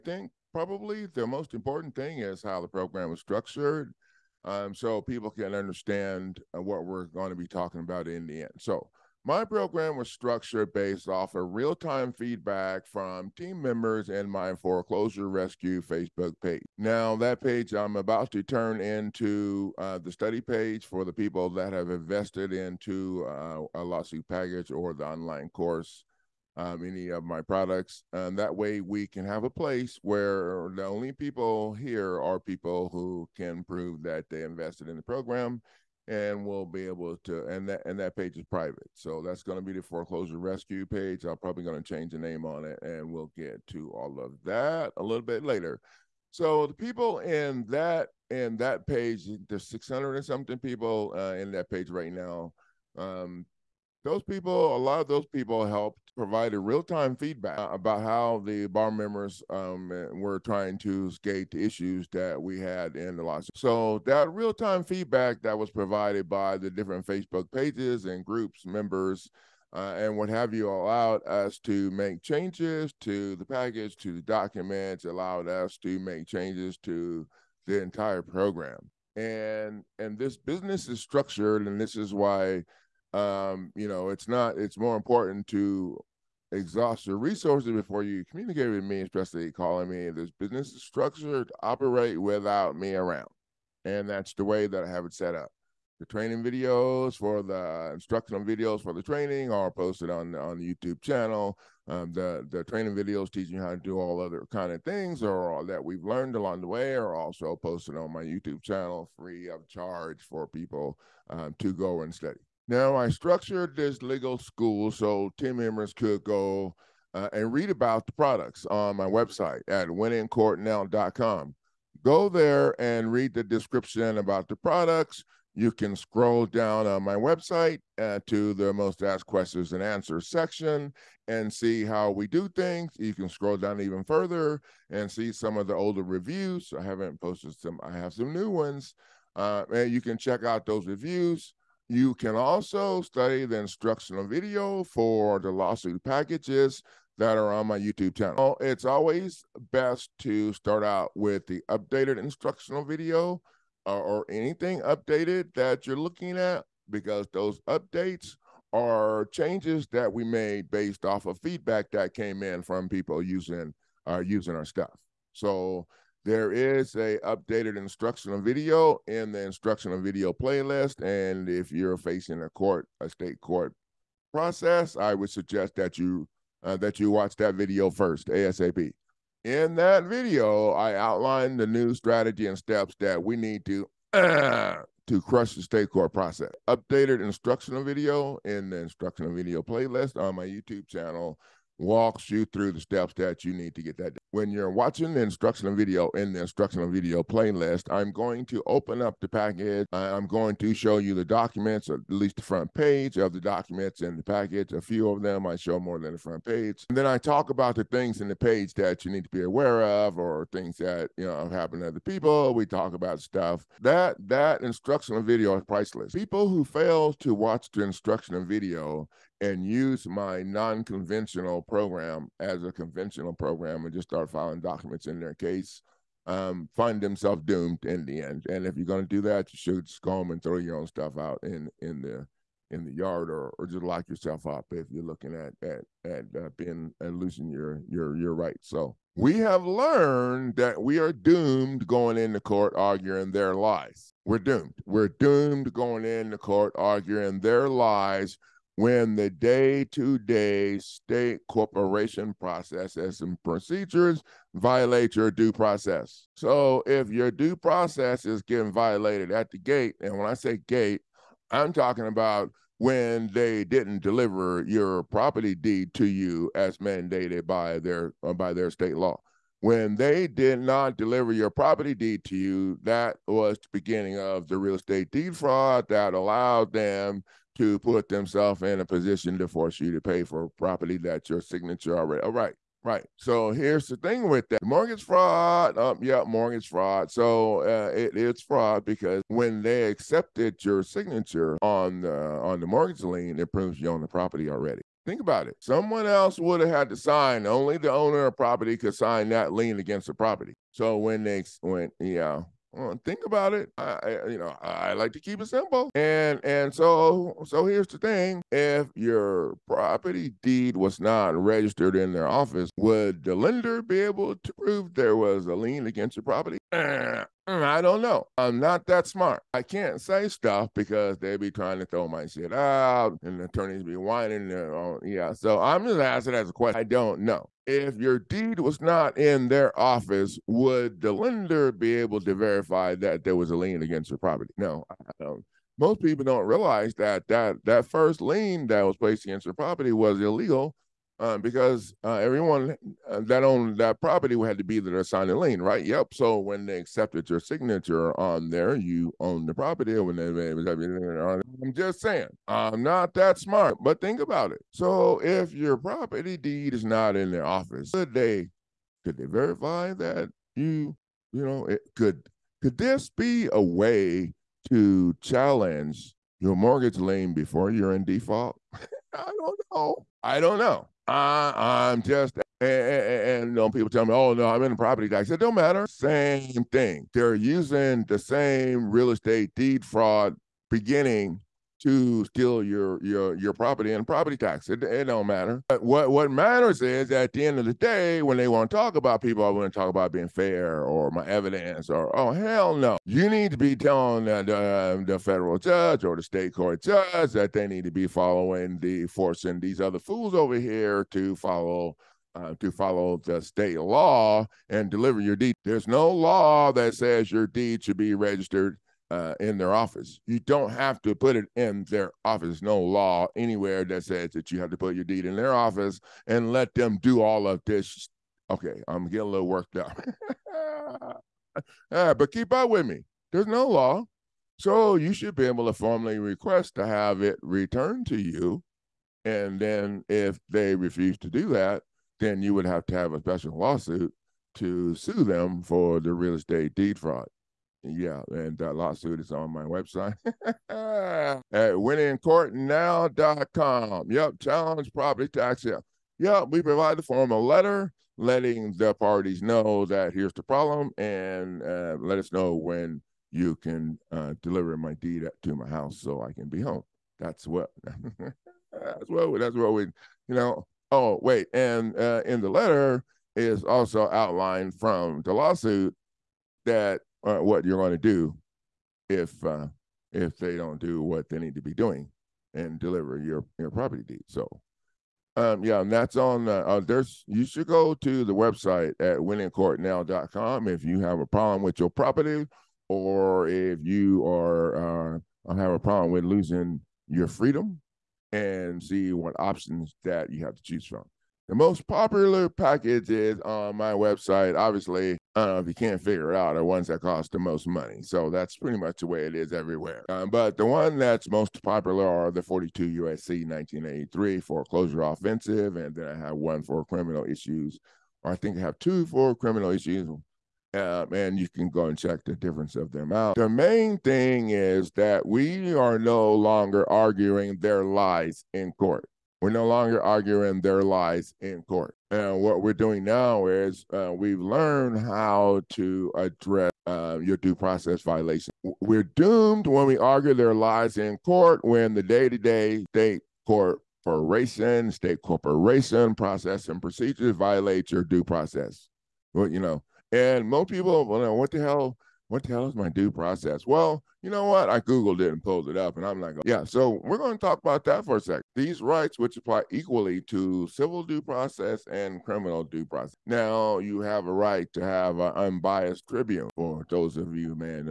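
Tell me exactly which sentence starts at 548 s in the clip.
These rights, which apply equally to civil due process and criminal due process.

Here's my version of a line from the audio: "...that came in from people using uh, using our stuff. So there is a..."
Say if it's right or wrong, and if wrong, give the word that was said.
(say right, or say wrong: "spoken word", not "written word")
right.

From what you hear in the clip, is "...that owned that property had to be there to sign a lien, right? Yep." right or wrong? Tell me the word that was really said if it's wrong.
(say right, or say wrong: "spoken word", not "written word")
right.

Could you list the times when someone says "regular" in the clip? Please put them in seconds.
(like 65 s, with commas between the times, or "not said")
not said.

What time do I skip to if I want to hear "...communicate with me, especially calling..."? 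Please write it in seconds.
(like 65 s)
88 s.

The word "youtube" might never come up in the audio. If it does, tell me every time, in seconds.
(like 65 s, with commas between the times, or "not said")
100 s, 108 s, 147 s, 190 s.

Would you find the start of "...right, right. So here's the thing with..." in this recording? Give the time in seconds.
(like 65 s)
282 s.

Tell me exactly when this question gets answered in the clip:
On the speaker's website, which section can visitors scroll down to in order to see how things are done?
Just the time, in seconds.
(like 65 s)
128 s.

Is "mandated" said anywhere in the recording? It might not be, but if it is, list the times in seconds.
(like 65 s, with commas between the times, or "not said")
266 s.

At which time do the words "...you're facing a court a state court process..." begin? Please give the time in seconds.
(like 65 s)
171 s.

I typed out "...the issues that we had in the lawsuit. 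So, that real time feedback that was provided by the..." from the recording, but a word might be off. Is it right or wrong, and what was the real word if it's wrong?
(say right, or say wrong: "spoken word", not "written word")
right.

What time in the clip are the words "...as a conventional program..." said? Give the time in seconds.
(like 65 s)
222 s.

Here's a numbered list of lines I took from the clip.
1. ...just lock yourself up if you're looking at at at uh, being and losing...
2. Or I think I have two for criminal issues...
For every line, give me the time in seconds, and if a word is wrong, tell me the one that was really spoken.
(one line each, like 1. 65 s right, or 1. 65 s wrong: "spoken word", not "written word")
1. 233 s right
2. 508 s right.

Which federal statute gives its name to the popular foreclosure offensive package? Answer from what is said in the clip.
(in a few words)
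42 USC 1983.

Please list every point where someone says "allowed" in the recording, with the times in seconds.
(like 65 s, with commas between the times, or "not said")
70 s, 75 s, 276 s.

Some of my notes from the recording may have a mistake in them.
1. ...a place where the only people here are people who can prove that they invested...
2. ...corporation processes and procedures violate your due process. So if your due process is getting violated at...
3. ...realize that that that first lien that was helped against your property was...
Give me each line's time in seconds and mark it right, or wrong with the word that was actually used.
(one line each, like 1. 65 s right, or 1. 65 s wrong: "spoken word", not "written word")
1. 29 s right
2. 251 s right
3. 336 s wrong: "placed", not "helped".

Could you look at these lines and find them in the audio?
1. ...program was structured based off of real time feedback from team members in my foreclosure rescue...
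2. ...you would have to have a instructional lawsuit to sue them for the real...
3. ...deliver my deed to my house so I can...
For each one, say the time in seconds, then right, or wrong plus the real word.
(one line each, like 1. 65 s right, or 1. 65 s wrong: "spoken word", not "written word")
1. 9 s right
2. 432 s wrong: "special", not "instructional"
3. 454 s right.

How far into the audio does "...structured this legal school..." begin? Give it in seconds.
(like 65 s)
113 s.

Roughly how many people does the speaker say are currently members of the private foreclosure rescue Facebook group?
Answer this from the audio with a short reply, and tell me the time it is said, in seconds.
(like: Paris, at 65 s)
600, at 49 s.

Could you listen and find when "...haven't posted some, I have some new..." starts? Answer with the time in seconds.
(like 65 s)
136 s.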